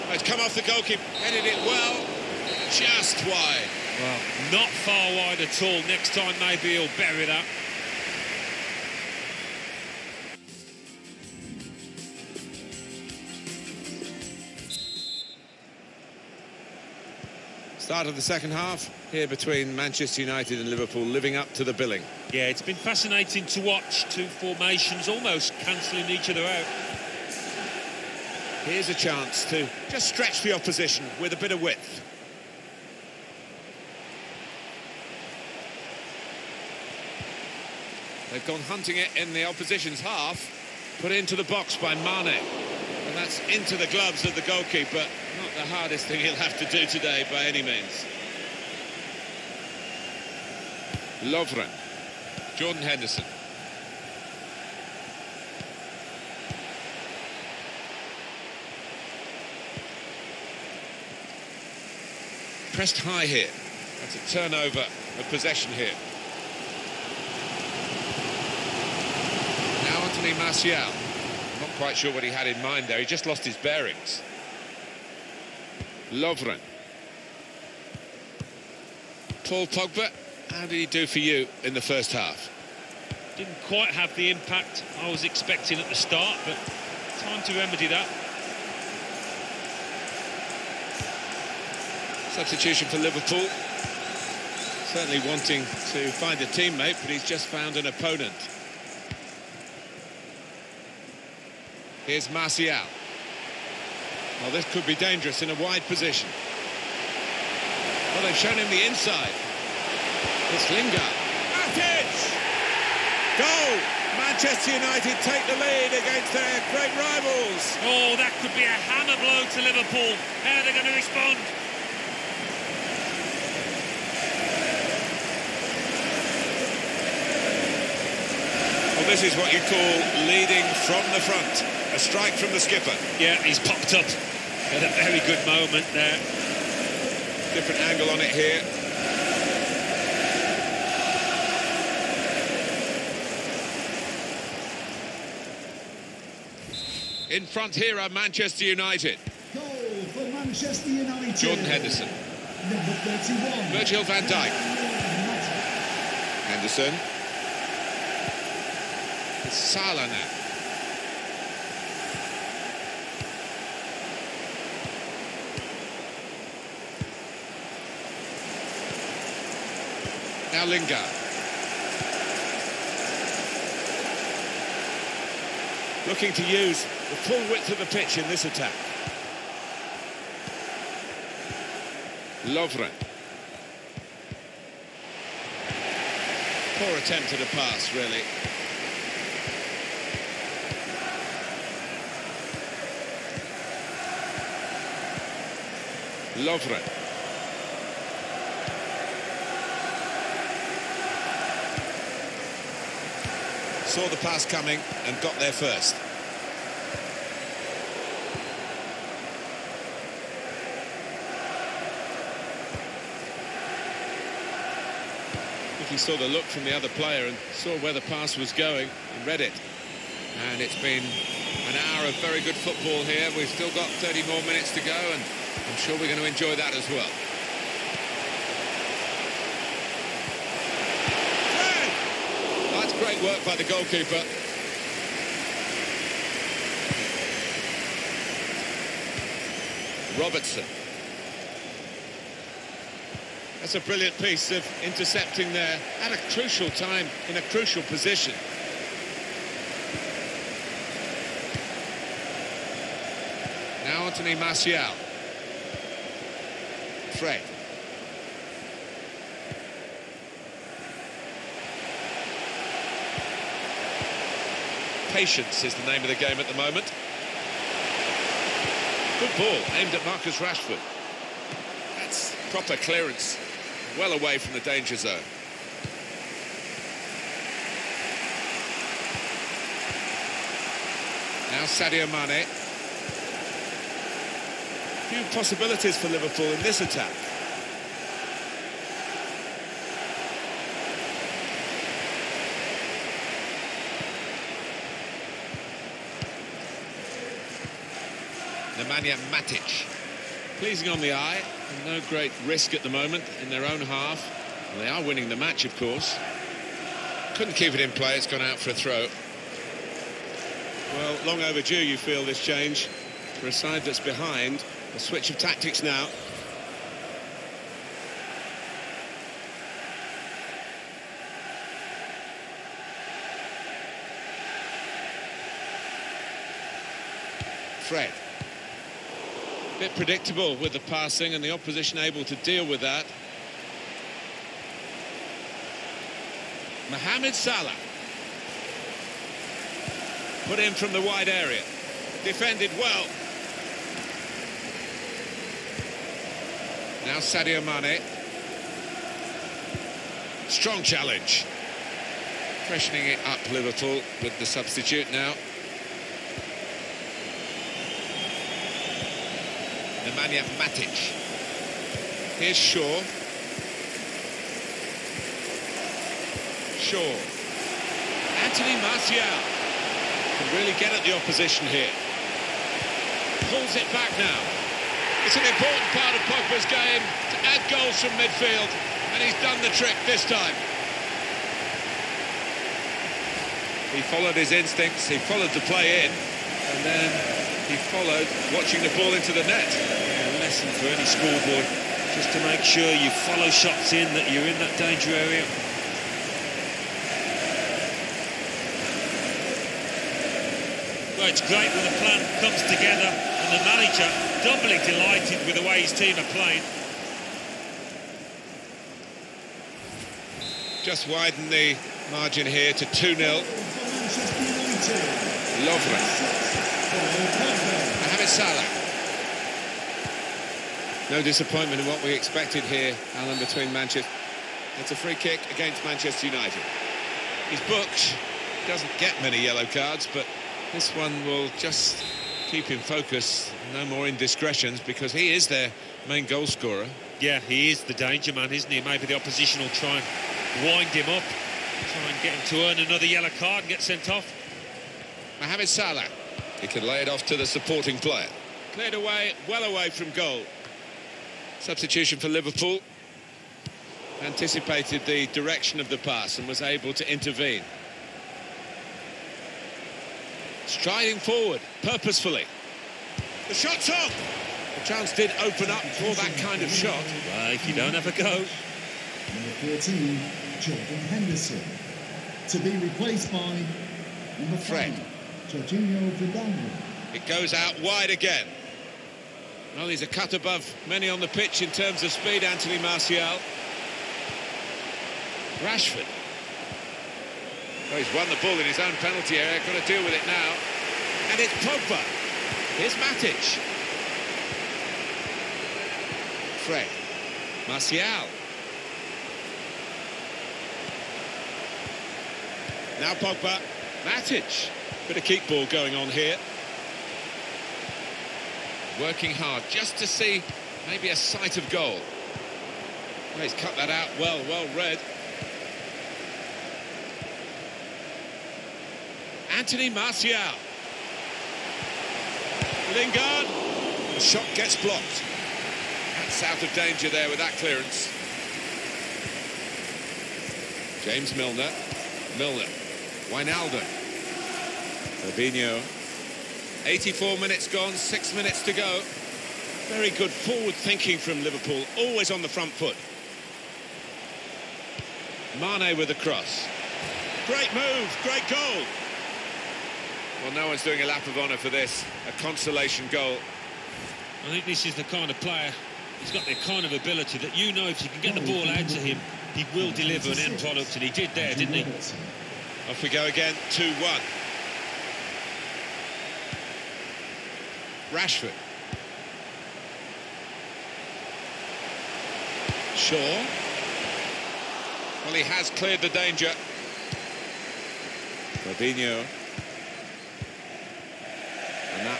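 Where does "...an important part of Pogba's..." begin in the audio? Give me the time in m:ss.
6:15.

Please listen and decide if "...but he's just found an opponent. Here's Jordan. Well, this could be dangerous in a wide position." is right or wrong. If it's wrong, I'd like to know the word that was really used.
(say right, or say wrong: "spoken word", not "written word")
wrong: "Martial", not "Jordan".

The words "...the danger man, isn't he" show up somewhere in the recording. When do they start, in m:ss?
7:17.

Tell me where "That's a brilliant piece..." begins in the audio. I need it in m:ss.
4:03.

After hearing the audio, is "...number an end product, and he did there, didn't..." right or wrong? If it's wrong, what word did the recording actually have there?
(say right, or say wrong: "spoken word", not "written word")
wrong: "deliver", not "number".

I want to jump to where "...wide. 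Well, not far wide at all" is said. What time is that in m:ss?
0:03.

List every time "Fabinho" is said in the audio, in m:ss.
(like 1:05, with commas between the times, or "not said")
8:55, 9:38.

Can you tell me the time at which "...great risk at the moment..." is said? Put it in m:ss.
5:02.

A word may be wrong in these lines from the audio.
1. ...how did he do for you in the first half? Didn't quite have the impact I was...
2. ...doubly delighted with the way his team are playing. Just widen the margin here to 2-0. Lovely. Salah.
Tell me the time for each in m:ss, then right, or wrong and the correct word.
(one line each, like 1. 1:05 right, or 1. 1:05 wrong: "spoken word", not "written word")
1. 1:20 right
2. 6:44 right.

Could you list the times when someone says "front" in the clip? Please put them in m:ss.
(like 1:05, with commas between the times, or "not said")
2:11, 2:27, 9:02.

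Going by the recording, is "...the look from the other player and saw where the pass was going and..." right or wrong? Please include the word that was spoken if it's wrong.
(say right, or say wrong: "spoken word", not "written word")
right.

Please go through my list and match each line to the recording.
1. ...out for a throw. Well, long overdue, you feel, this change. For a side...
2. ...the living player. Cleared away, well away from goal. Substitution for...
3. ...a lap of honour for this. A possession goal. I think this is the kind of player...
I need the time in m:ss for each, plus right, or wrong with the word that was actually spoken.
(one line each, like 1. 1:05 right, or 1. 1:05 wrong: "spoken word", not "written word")
1. 5:08 right
2. 7:27 wrong: "supporting", not "living"
3. 9:11 wrong: "consolation", not "possession".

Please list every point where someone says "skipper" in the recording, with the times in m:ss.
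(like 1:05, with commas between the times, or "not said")
2:12.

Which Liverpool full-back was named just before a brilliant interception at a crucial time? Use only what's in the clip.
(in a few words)
Robertson.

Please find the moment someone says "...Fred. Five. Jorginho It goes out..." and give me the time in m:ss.
7:54.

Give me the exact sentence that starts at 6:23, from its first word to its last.
He followed his instincts, he followed the play in, and then he followed, watching the ball into the net.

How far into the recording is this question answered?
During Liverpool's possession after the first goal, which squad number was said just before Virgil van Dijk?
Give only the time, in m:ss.
2:32.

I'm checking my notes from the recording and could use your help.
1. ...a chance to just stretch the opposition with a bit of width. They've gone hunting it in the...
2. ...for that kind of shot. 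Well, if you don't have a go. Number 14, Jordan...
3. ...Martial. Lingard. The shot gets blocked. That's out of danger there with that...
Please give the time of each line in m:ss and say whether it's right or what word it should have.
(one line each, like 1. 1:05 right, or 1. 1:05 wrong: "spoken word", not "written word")
1. 0:28 right
2. 7:45 right
3. 8:39 right.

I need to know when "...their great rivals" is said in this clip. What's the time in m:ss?
1:56.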